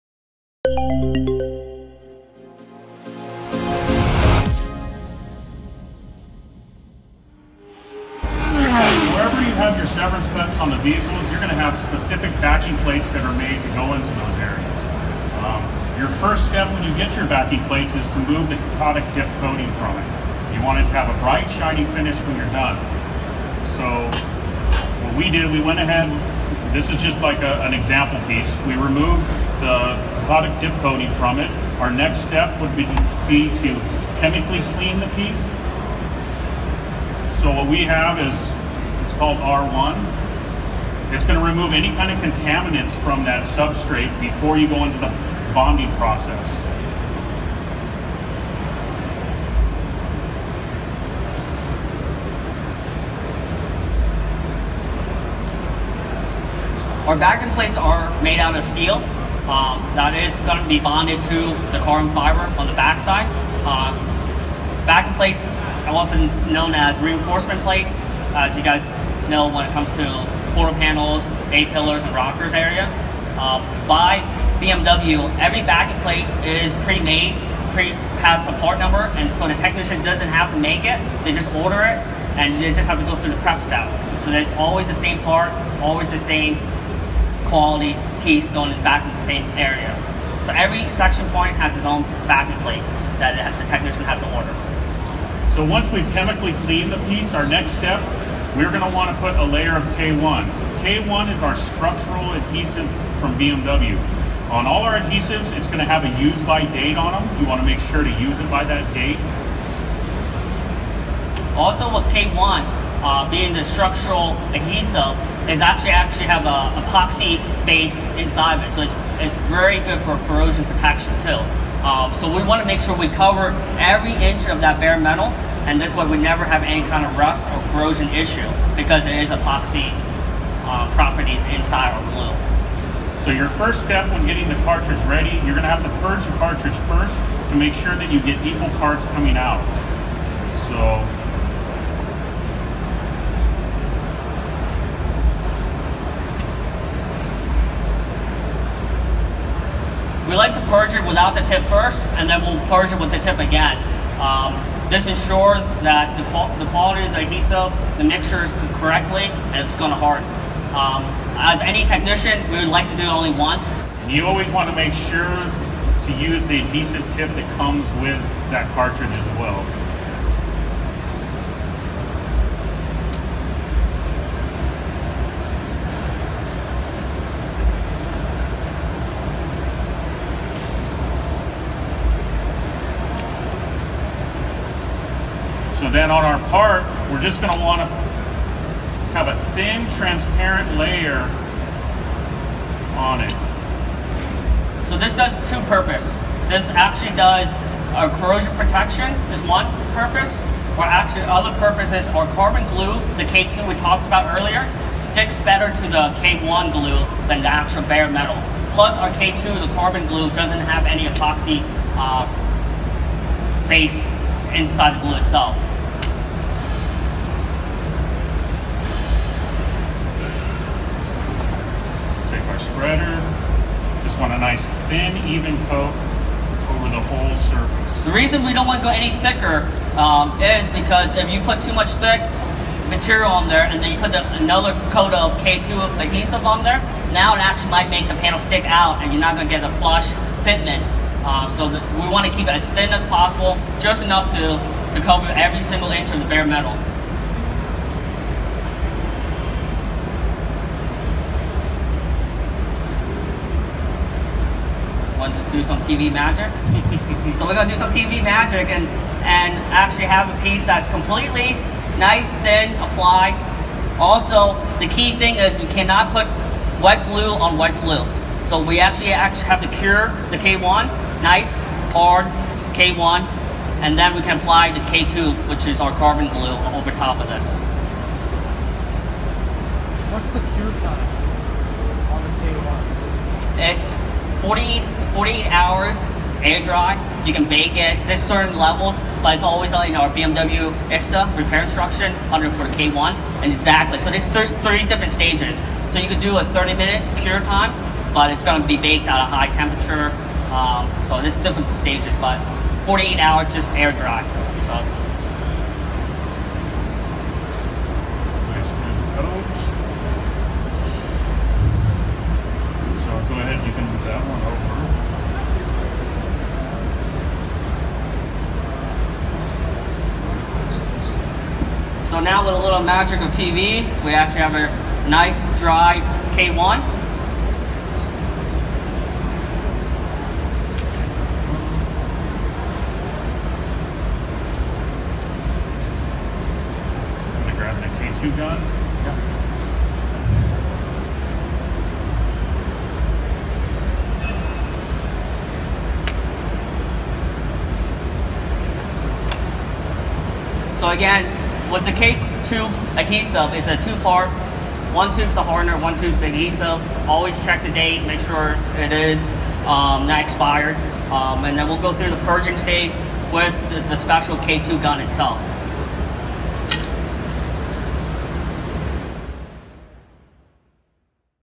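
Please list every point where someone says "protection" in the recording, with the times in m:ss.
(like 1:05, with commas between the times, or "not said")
2:00, 3:18.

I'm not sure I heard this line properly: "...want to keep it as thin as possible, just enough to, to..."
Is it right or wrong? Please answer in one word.
right.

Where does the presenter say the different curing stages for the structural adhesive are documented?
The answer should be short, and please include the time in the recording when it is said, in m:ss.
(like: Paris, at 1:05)
BMW ISTA repair instruction, at 4:50.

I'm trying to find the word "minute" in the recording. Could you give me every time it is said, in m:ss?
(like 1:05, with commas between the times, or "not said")
4:56.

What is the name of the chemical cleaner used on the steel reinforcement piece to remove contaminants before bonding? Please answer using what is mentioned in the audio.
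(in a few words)
R1.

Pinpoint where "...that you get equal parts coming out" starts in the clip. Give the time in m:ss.
2:17.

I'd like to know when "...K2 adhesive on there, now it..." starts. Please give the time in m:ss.
3:55.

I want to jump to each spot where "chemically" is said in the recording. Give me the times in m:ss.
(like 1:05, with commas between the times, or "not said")
0:34, 1:36.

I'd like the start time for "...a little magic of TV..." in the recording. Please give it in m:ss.
5:22.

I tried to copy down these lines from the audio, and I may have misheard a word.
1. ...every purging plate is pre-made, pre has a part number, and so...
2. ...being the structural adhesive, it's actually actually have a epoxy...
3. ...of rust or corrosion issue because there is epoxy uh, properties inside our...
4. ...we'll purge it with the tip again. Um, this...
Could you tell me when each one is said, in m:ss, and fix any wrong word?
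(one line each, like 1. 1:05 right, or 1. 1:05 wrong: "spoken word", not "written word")
1. 1:15 wrong: "backing", not "purging"
2. 1:53 right
3. 2:07 right
4. 2:32 right.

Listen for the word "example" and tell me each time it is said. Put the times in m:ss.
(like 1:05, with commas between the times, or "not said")
0:27.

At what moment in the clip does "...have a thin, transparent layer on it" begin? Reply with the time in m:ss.
3:09.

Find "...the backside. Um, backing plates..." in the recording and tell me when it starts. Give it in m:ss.
1:02.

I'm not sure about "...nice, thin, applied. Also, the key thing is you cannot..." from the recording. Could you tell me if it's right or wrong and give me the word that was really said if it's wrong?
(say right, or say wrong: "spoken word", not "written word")
right.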